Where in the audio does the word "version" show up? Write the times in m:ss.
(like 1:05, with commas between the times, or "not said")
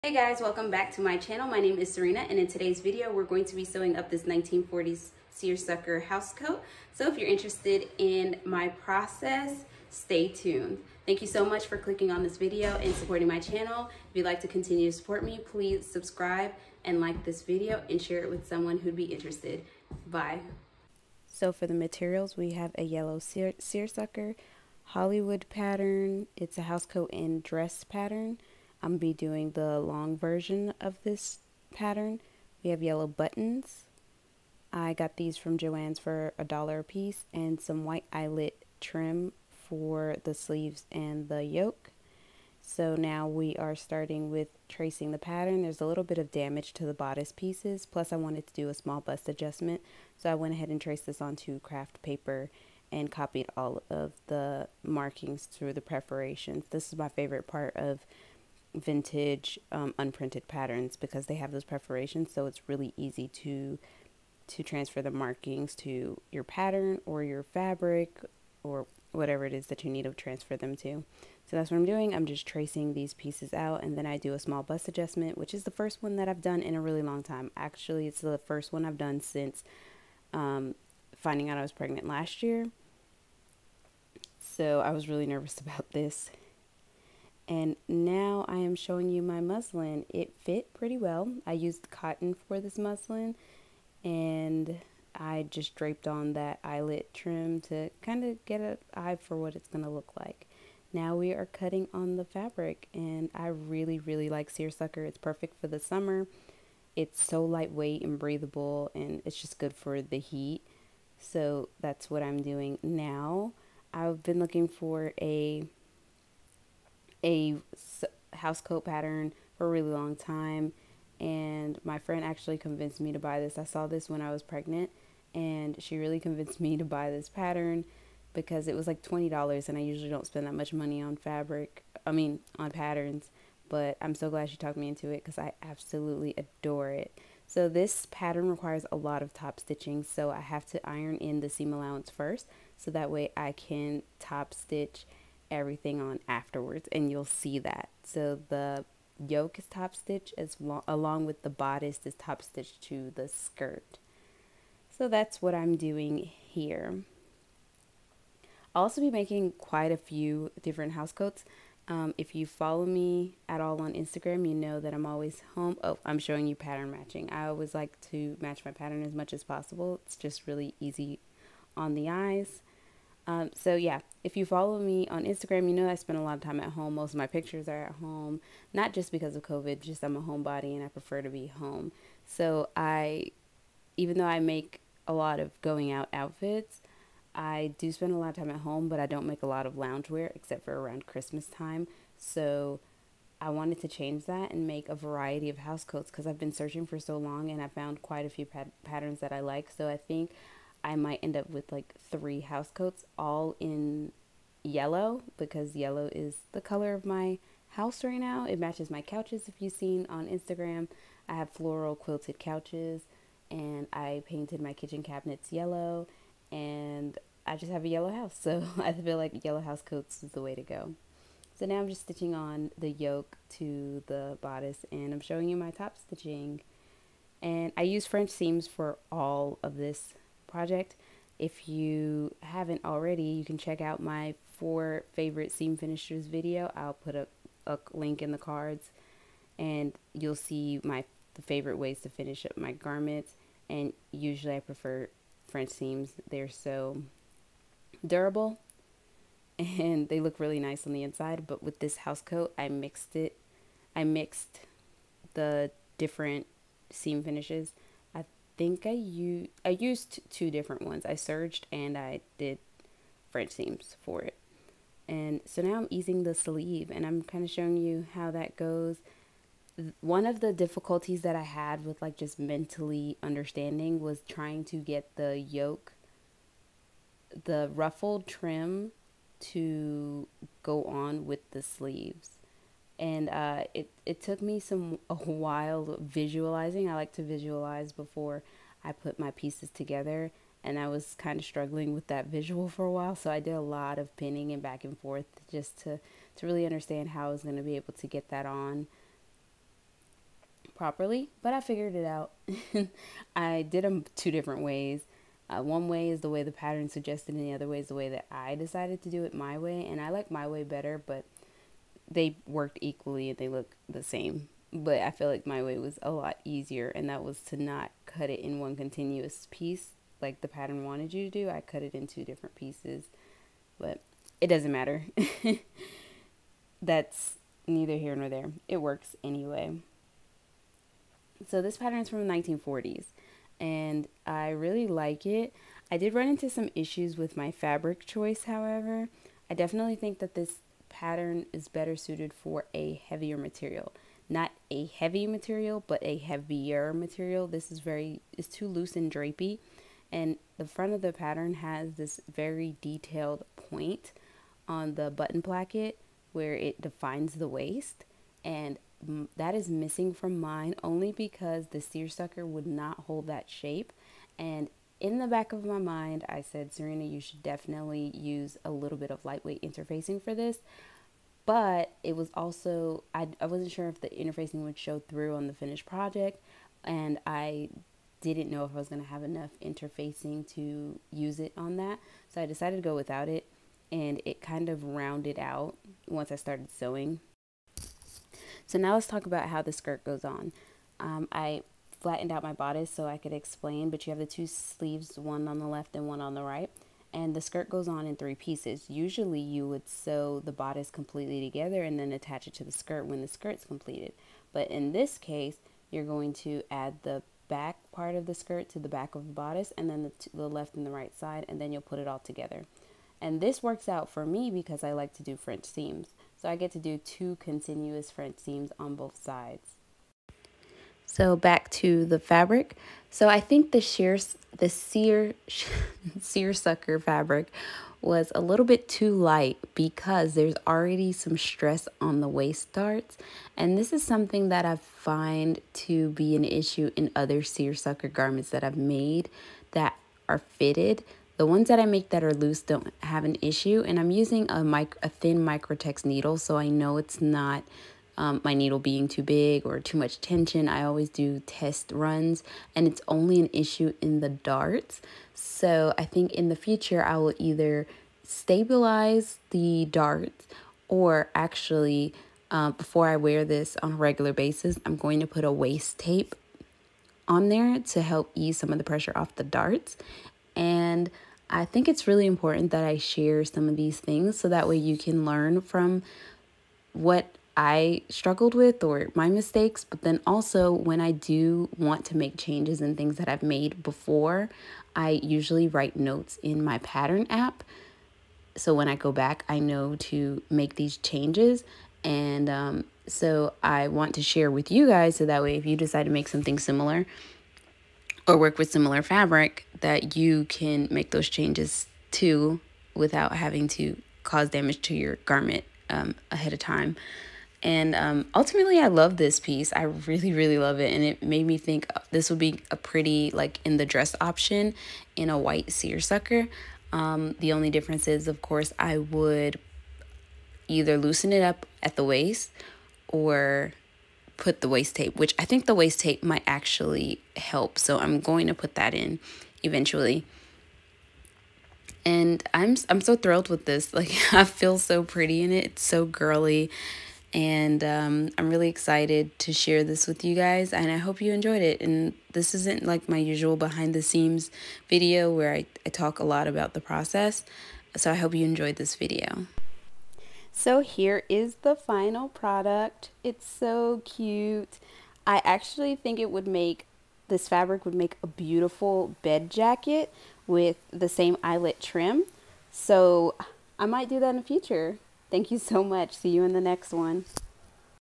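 0:30.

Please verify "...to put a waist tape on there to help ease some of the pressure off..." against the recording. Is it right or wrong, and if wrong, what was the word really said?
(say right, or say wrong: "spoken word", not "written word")
right.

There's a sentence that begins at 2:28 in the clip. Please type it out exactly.
So the yoke is top stitch as lo- along with the bodice is top stitch to the skirt.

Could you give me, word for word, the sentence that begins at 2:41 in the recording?
Um, if you follow me at all on Instagram, you know that I'm always home.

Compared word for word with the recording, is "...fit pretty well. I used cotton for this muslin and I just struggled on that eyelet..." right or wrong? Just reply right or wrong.
wrong.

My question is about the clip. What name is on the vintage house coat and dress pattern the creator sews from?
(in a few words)
Hollywood.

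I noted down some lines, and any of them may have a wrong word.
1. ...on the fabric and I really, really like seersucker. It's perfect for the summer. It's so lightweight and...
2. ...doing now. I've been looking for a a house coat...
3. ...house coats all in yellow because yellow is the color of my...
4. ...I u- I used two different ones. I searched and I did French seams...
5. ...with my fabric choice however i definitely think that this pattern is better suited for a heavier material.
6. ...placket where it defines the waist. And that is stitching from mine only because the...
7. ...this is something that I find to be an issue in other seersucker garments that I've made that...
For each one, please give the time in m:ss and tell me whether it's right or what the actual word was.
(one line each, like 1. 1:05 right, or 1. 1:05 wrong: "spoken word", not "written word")
1. 1:41 right
2. 1:52 right
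3. 3:22 right
4. 4:18 right
5. 5:37 right
6. 5:55 wrong: "missing", not "stitching"
7. 7:13 right.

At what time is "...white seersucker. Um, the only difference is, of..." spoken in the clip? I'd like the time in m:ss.
8:35.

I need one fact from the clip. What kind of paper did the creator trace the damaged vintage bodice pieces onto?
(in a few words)
craft paper.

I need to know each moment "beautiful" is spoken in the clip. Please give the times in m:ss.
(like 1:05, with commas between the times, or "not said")
9:18.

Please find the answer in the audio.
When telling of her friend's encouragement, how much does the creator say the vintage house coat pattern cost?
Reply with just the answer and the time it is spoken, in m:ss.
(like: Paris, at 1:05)
$20, at 2:09.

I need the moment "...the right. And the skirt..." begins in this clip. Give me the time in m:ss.
6:36.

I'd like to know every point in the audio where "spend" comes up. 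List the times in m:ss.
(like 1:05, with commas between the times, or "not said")
2:10, 2:55, 3:07.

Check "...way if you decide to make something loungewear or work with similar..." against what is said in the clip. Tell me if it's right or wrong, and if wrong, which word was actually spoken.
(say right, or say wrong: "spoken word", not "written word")
wrong: "similar", not "loungewear".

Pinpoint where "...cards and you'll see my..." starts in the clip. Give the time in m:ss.
3:58.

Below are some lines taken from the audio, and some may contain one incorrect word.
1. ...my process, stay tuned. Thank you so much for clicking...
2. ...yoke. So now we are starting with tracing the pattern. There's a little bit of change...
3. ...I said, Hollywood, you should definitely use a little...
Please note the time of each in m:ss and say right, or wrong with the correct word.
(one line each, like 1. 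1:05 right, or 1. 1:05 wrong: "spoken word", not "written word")
1. 0:08 right
2. 0:41 wrong: "damage", not "change"
3. 6:06 wrong: "Serena", not "Hollywood".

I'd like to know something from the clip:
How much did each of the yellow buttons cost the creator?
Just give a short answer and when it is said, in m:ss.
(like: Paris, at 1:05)
a dollar, at 0:36.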